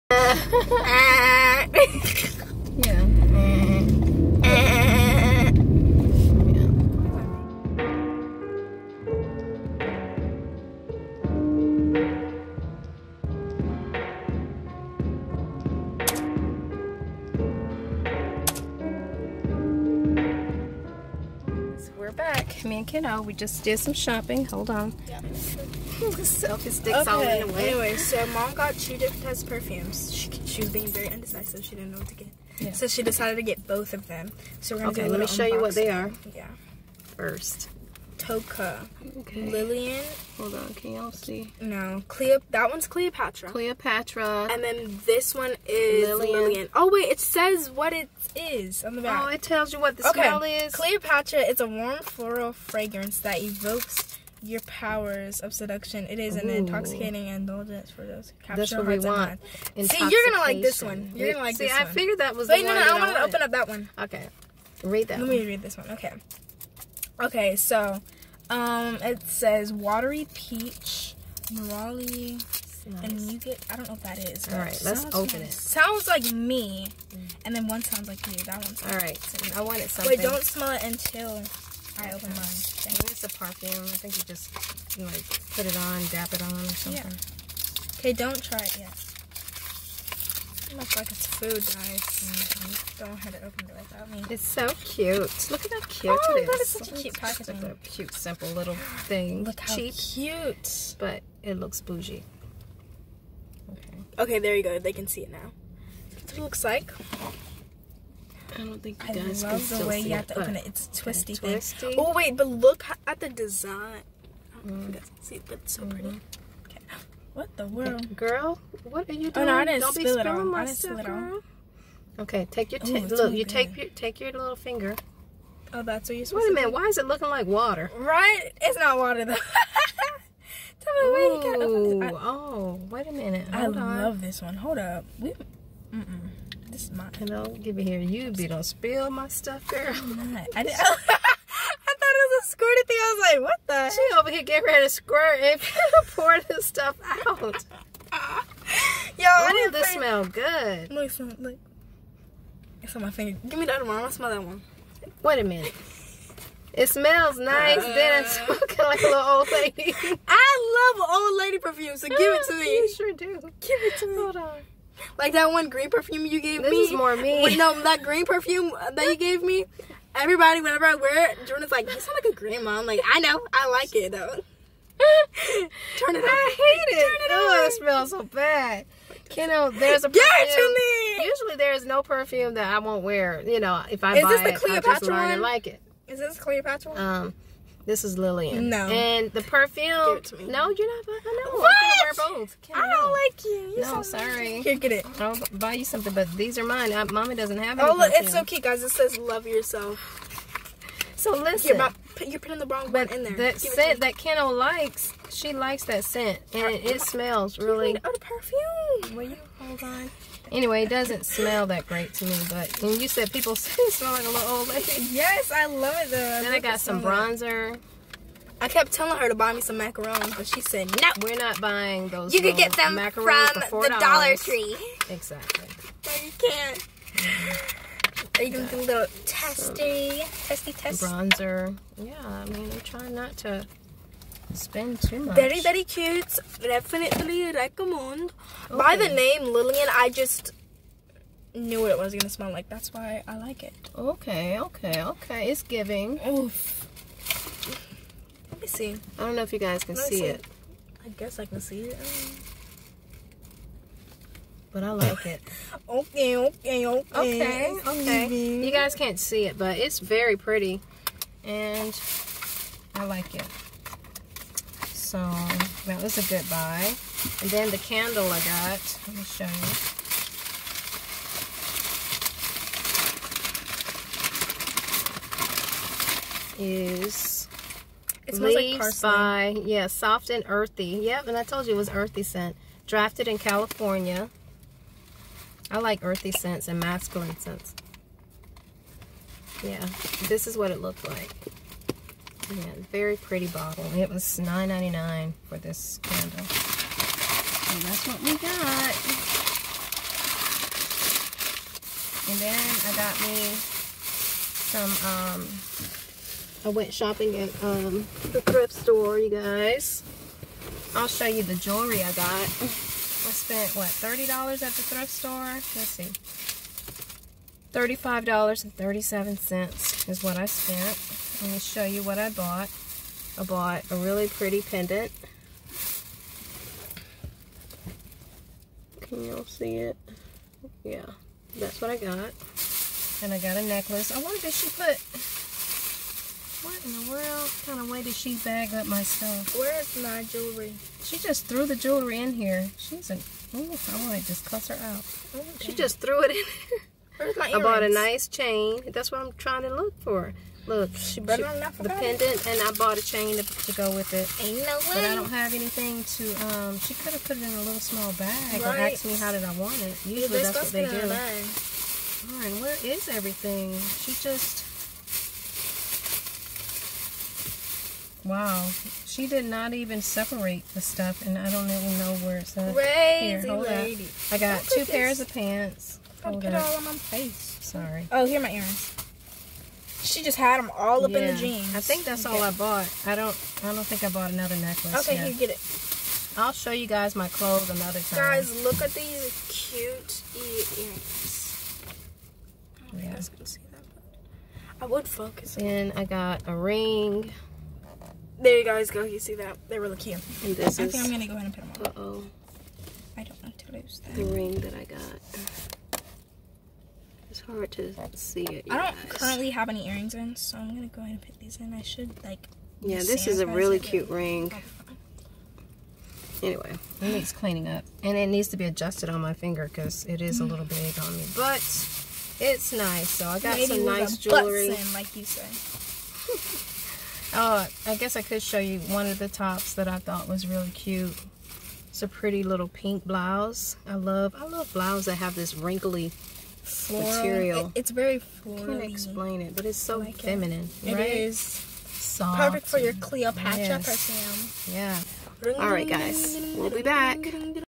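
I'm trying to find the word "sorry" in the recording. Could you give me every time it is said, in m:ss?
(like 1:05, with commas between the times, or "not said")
3:14, 6:17.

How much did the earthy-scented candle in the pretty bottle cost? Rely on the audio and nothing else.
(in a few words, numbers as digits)
$9.99.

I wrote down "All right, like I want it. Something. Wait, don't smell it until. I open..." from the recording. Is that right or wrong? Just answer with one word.
right.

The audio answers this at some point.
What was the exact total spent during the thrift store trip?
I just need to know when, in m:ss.
5:17.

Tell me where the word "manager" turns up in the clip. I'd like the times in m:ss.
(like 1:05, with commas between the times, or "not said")
not said.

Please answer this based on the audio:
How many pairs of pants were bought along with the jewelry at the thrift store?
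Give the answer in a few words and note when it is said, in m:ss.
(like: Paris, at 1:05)
2, at 6:14.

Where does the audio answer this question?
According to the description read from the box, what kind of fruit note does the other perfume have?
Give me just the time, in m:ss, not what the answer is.
1:09.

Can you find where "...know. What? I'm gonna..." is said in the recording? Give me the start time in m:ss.
3:11.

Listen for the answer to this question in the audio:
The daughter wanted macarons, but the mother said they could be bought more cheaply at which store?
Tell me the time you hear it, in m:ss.
3:43.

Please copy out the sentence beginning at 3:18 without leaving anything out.
It says "Love Yourself." So listen, you're, put, you're putting the wrong one in there.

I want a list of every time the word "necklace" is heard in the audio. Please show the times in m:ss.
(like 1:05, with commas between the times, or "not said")
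5:33, 6:24.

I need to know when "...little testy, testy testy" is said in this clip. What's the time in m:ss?
3:48.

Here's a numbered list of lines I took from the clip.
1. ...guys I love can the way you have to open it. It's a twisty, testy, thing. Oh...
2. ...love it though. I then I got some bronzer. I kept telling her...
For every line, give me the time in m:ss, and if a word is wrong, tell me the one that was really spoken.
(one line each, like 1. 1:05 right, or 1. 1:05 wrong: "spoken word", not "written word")
1. 1:49 wrong: "twisty", not "testy"
2. 3:35 right.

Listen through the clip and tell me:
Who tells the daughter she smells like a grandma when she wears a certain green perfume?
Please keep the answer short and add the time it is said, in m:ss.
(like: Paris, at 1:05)
Jordan, at 2:51.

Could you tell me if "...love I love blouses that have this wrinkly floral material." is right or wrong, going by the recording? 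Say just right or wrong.
right.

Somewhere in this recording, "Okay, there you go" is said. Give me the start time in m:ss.
1:44.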